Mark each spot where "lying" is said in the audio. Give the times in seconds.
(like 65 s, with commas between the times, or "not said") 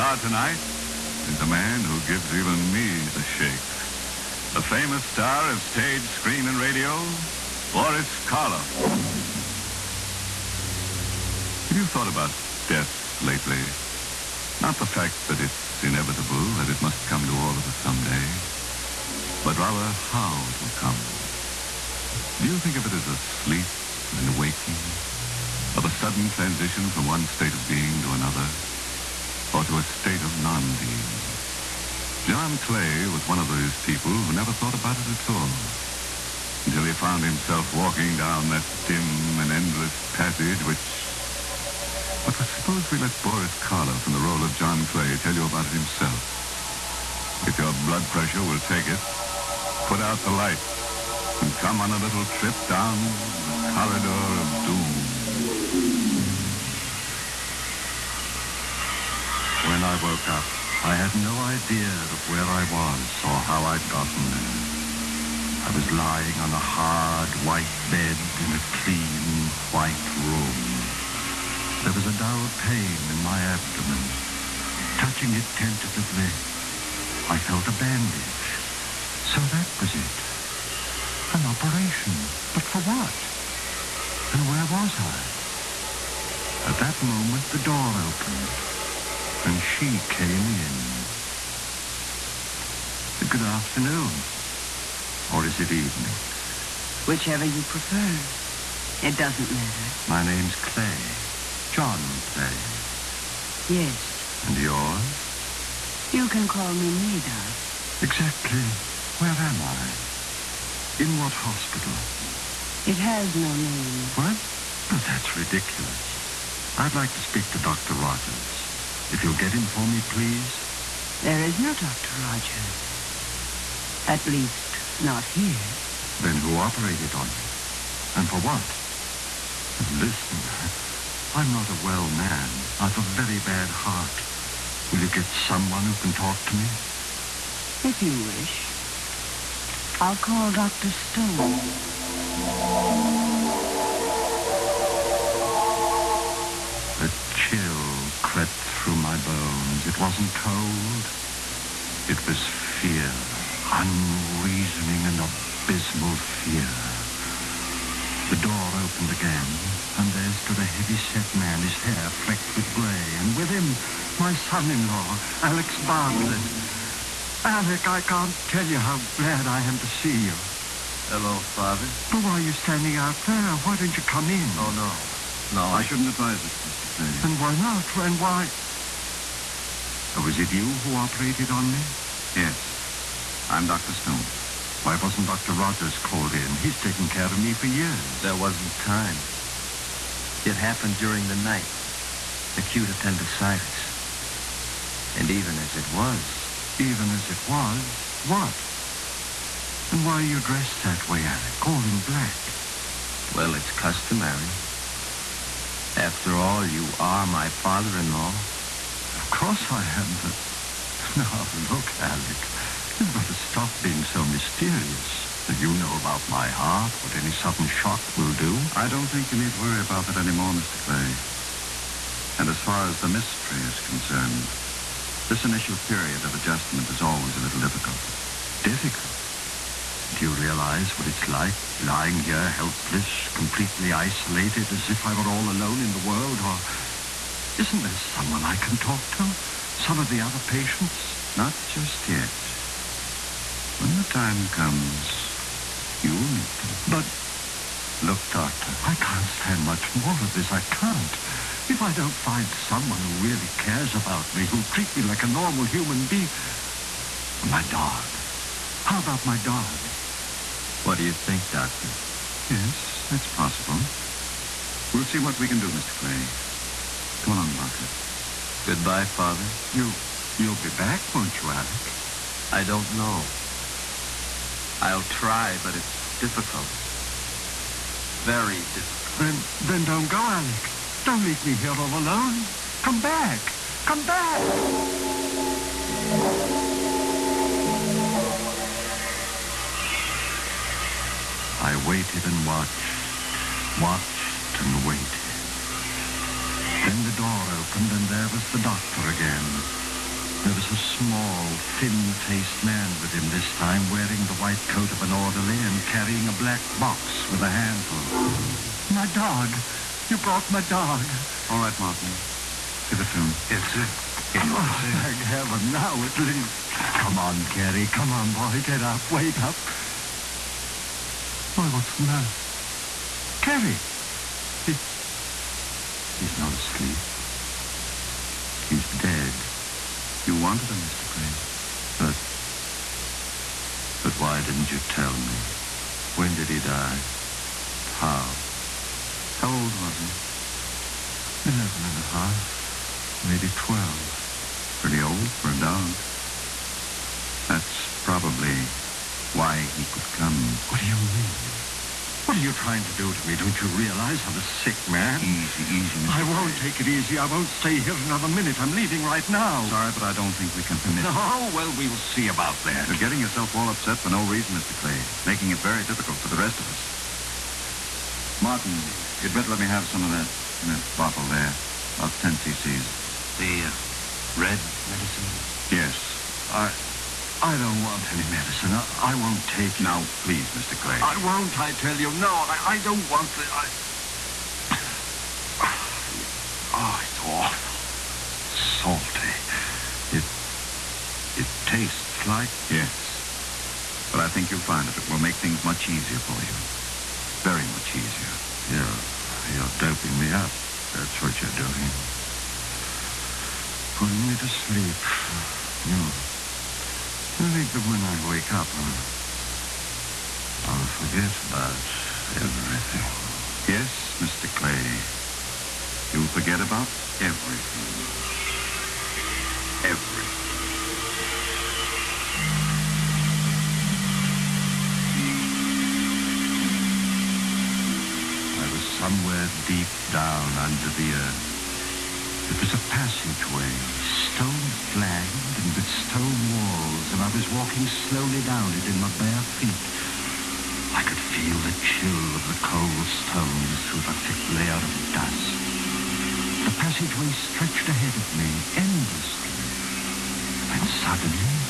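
65 s, 231 s.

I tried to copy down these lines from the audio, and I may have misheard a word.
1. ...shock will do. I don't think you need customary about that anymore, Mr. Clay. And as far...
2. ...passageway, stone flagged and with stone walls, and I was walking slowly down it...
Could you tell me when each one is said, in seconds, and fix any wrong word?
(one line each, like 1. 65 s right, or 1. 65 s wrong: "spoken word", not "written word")
1. 217 s wrong: "worry", not "customary"
2. 432 s right.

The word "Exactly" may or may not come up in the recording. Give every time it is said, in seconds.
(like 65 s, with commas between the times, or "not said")
108 s.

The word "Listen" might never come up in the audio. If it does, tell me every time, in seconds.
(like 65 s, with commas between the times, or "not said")
129 s.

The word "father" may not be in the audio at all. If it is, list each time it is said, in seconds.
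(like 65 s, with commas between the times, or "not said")
171 s, 207 s, 269 s.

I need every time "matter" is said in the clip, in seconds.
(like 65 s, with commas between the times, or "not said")
99 s, 322 s.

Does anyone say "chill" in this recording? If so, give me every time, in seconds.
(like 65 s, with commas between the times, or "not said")
147 s, 441 s.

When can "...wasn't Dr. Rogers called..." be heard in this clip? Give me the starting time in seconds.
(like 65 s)
185 s.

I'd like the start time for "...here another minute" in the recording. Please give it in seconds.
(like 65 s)
357 s.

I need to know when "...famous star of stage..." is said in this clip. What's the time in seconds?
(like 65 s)
4 s.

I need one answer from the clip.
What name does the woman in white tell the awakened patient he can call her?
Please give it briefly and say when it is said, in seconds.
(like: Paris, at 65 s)
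Nada, at 106 s.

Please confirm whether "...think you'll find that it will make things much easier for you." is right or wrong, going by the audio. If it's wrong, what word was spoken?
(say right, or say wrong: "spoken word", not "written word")
right.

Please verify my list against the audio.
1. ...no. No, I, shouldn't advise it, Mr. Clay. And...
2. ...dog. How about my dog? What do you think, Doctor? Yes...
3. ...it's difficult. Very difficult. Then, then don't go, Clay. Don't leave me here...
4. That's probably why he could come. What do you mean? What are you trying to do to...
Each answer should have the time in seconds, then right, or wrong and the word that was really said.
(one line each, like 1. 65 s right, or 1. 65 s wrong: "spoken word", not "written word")
1. 174 s right
2. 257 s right
3. 275 s wrong: "Alec", not "Clay"
4. 347 s right.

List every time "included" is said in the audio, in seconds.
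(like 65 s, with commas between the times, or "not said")
not said.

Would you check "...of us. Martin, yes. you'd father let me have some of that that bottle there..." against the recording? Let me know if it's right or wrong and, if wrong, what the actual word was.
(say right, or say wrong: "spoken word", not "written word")
wrong: "better", not "father".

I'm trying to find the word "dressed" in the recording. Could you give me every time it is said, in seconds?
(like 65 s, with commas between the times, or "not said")
200 s.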